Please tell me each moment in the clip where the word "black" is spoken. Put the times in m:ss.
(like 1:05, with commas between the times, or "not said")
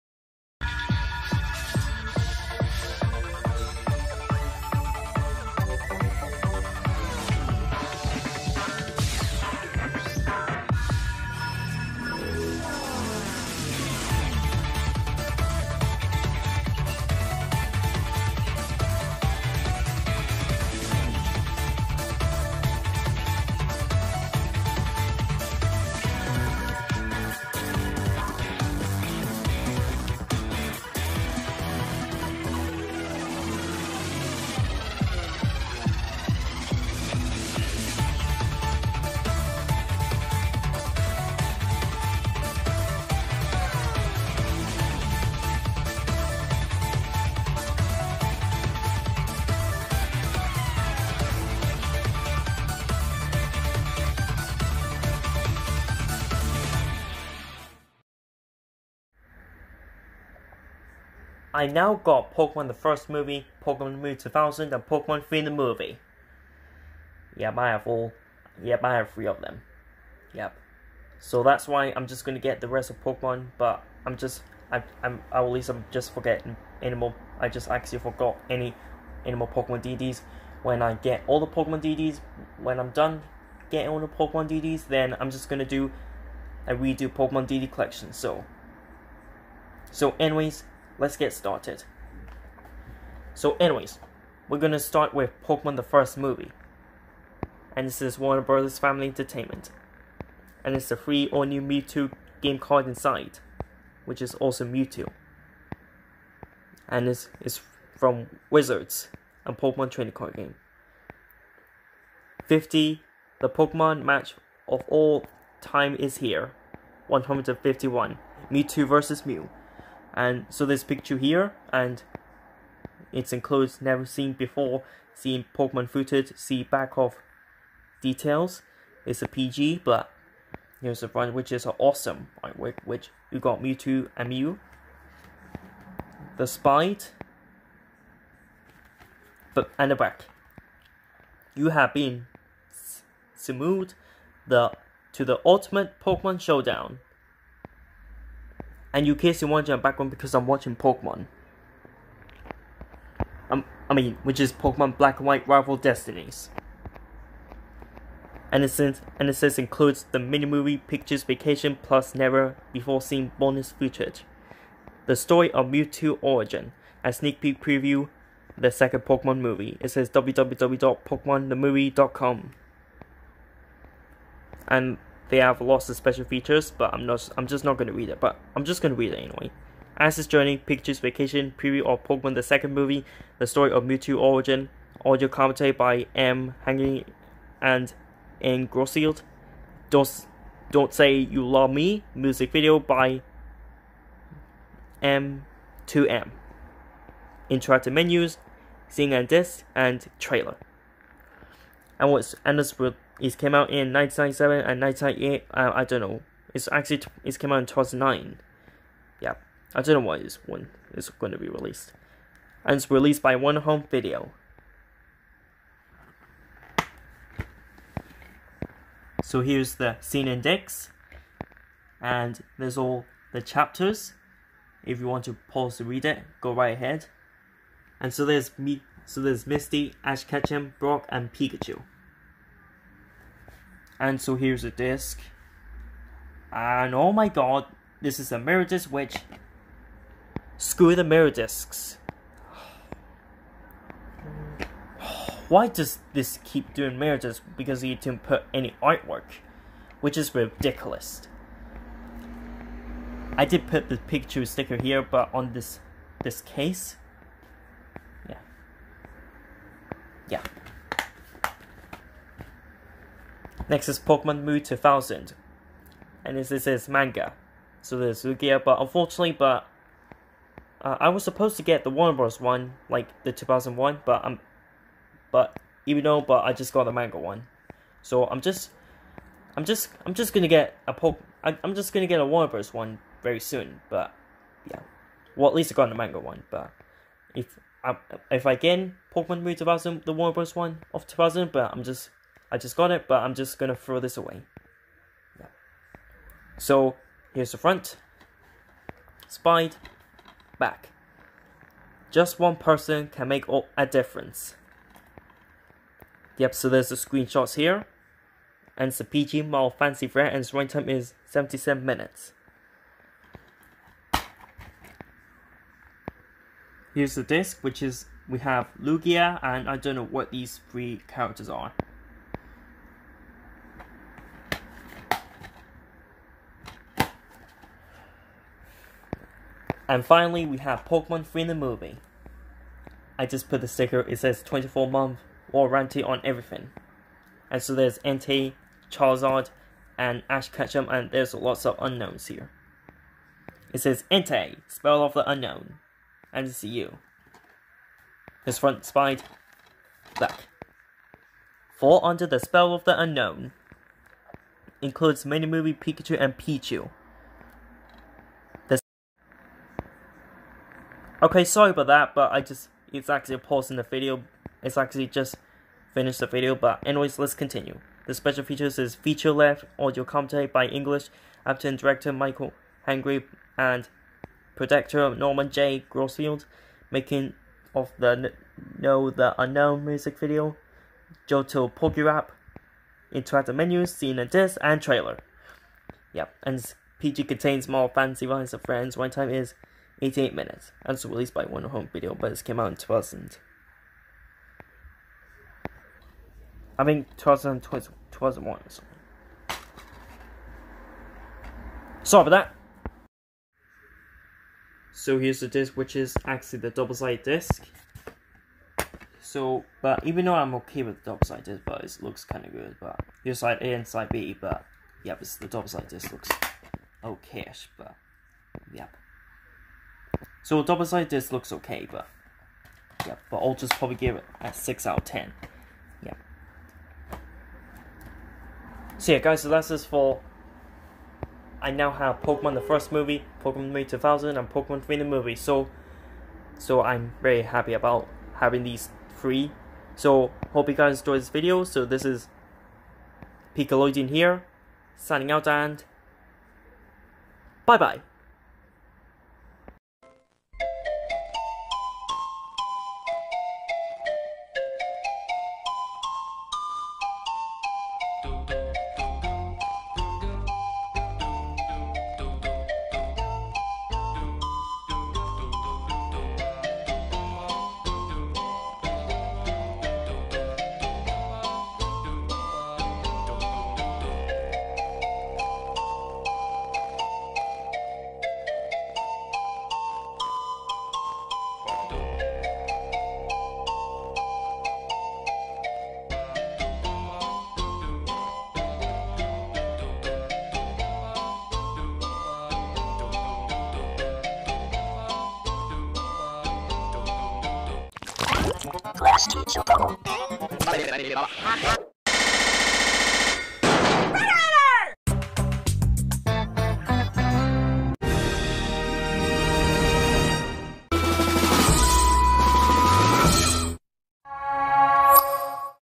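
2:34, 5:50.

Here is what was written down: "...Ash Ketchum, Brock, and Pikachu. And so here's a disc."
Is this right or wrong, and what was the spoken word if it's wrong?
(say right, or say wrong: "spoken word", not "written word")
right.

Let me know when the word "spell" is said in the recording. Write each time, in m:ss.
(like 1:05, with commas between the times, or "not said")
5:44, 5:52.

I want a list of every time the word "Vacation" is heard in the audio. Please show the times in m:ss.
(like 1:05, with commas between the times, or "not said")
2:41, 3:00.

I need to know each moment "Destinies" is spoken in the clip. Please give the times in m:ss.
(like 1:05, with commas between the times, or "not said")
2:35.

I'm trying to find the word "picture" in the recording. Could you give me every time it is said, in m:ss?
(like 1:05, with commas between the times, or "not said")
2:00, 4:13.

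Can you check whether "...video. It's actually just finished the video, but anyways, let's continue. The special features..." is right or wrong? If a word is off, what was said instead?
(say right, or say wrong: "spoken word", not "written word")
right.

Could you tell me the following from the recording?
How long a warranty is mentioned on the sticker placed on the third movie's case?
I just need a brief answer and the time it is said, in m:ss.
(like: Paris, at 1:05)
24 months, at 5:34.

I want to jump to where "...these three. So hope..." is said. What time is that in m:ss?
7:18.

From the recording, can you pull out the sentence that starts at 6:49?
So, but even though I'm okay with the double side disc, but it looks kind of good.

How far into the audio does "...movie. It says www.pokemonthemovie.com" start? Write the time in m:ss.
2:49.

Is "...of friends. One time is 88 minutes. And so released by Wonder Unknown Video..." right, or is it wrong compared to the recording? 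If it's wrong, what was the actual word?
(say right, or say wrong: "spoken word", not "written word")
wrong: "Home", not "Unknown".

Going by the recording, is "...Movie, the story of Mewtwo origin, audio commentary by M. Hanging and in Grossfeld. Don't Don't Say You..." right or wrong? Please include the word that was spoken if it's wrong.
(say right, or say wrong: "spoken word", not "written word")
right.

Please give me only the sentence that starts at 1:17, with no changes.
I just actually forgot any animal Pokemon DDs.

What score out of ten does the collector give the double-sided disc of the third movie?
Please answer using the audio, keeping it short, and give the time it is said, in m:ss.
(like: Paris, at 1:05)
6, at 7:04.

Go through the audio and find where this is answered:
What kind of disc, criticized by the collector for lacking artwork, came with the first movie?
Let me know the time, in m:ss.
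3:58.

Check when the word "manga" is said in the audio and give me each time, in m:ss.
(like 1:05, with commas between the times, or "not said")
4:26, 4:36, 4:45.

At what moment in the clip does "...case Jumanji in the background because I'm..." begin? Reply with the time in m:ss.
2:29.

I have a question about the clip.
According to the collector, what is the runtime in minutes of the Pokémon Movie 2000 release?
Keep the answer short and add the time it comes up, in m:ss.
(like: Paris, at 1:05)
77 minutes, at 5:11.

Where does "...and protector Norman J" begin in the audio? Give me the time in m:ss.
6:13.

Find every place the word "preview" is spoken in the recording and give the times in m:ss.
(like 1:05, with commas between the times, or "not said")
2:47, 3:01.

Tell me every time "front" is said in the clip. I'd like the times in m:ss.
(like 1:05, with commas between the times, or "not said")
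2:11, 4:57, 5:48.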